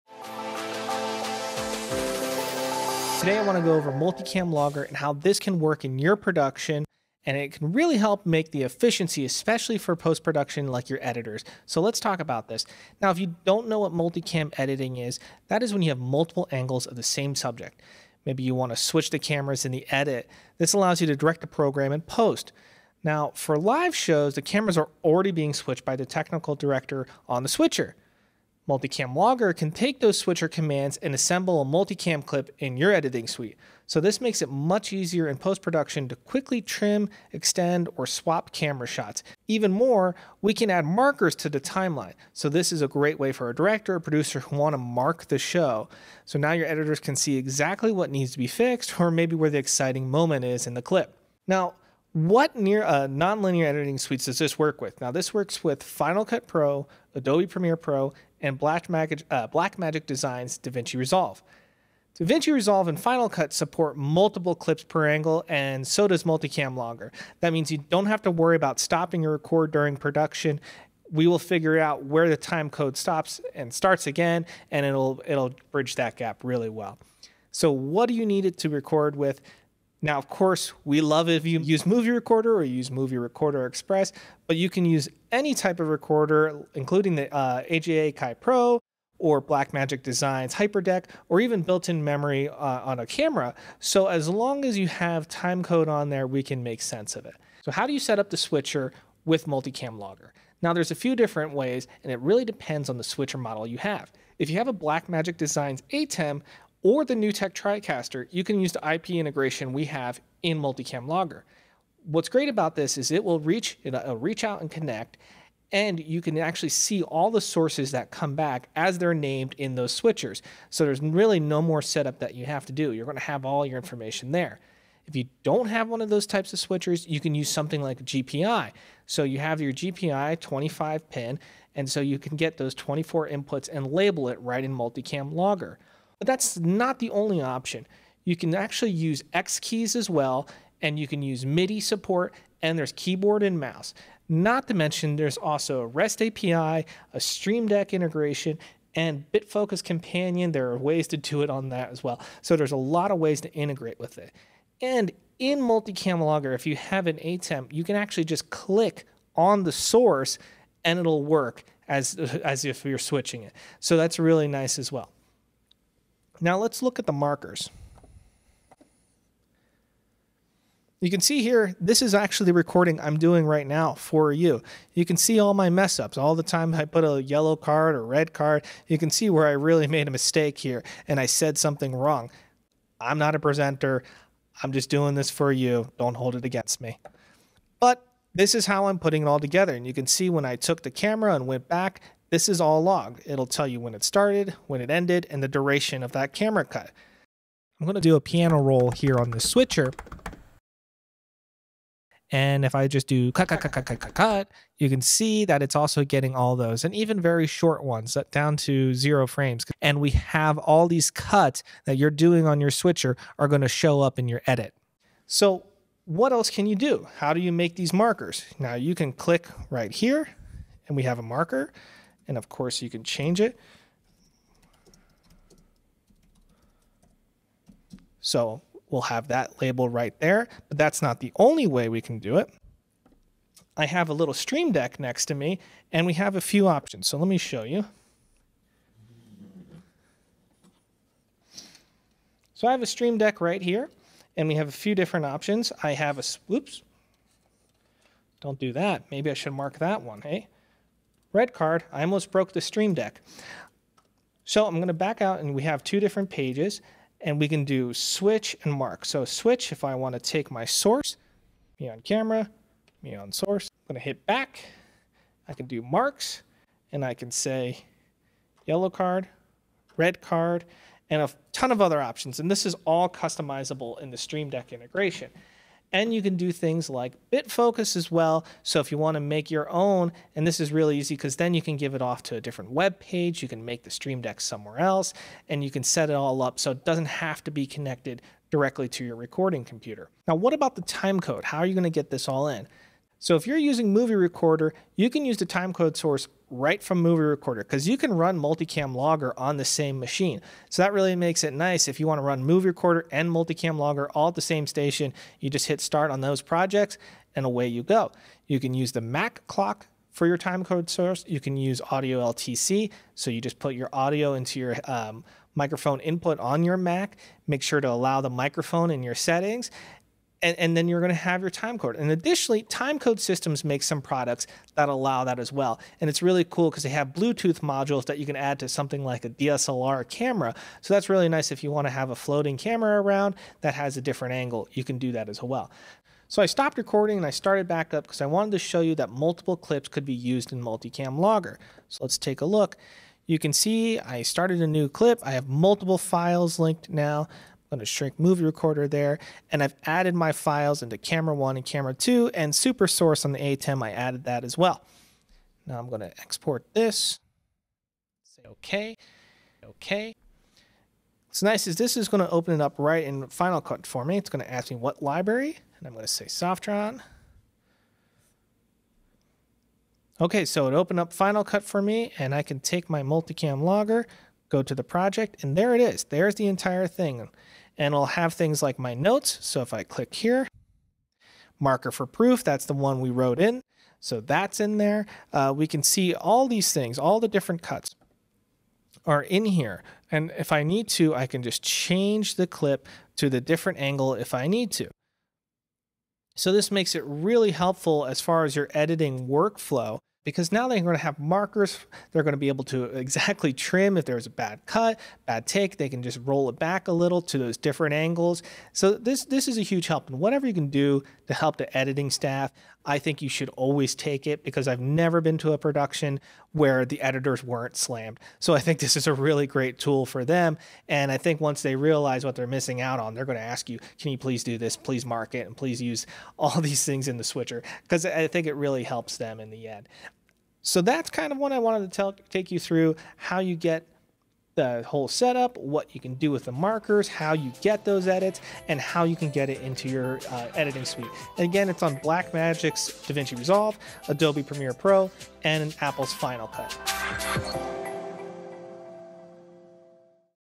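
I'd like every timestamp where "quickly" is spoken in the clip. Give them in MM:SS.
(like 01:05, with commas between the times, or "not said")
00:36.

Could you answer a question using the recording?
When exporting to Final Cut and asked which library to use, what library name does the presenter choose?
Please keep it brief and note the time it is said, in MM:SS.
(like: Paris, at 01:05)
Softron, at 06:06.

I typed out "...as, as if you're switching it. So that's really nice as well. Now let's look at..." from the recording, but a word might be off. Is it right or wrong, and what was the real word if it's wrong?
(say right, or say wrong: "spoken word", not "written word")
right.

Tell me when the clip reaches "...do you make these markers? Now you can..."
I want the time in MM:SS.
03:37.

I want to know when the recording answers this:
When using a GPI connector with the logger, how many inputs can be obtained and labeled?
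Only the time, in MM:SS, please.
02:12.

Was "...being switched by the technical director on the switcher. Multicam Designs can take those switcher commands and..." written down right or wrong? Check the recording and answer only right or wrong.
wrong.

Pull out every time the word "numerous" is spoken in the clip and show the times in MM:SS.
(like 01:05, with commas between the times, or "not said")
not said.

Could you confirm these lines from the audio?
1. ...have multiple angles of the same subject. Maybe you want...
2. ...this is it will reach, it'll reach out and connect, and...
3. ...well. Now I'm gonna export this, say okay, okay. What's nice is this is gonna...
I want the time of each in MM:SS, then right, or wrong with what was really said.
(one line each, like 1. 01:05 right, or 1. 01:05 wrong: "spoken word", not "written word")
1. 00:15 right
2. 01:52 right
3. 05:54 right.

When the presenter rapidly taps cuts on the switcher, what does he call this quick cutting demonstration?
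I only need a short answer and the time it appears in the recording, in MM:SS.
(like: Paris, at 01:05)
piano roll, at 03:18.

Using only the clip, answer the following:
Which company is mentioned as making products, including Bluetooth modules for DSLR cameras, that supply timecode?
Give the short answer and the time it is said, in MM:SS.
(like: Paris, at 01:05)
Timecode Systems, at 05:22.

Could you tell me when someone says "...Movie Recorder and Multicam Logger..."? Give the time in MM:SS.
05:02.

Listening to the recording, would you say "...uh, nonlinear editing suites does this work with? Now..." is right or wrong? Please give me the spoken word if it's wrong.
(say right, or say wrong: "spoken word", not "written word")
right.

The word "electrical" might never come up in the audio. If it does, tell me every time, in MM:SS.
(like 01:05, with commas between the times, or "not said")
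not said.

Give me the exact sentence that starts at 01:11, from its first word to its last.
We will figure out where the time code stops and starts again, and it'll it'll bridge that gap really well.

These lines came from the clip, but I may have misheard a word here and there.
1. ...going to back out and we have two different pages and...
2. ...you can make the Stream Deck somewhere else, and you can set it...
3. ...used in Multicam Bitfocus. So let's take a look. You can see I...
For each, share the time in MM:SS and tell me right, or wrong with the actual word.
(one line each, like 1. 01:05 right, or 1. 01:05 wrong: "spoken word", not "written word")
1. 04:14 right
2. 04:43 right
3. 05:40 wrong: "Logger", not "Bitfocus".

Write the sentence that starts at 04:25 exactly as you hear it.
I can do marks and I can say yellow card, red card, and a ton of other options.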